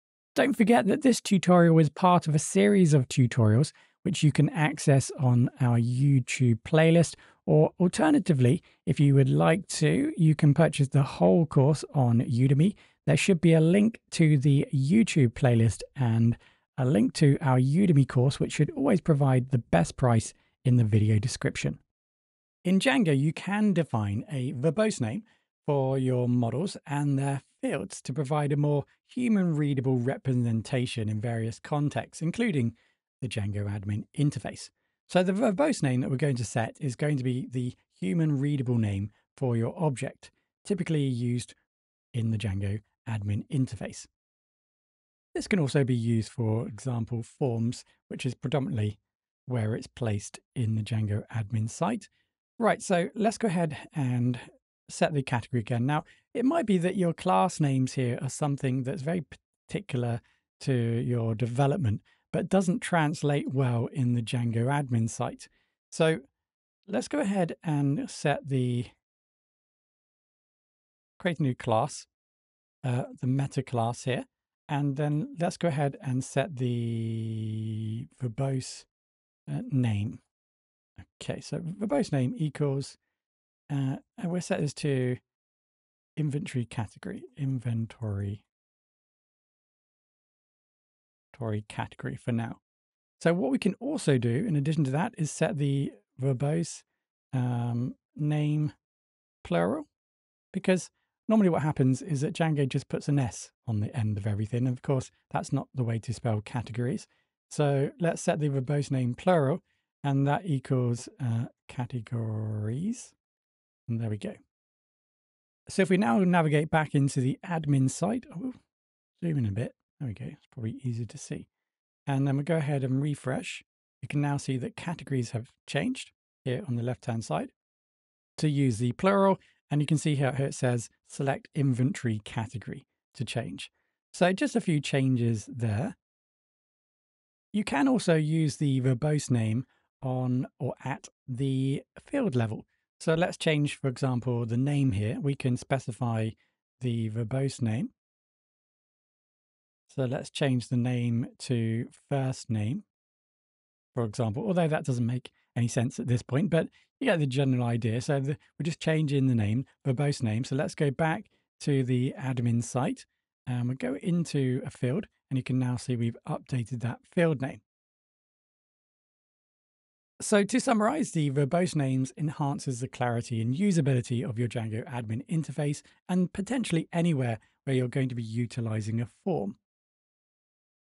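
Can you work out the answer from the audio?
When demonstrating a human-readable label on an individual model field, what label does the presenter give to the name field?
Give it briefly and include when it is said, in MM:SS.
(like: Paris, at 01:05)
first name, at 02:32.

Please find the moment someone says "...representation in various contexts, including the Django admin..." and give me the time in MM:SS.
00:29.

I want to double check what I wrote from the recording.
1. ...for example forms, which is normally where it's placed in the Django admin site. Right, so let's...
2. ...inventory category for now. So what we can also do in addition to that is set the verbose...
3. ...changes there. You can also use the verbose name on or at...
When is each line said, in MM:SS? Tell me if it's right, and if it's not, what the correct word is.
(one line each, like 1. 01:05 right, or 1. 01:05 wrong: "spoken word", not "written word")
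1. 00:46 wrong: "predominantly", not "normally"
2. 01:31 right
3. 02:14 right.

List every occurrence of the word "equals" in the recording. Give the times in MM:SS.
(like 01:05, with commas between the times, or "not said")
01:22, 01:50.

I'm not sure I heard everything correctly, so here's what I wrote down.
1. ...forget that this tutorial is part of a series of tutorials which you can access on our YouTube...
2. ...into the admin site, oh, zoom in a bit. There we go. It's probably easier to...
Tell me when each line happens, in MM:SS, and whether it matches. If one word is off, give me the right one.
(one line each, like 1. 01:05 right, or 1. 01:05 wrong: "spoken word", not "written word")
1. 00:00 right
2. 01:56 right.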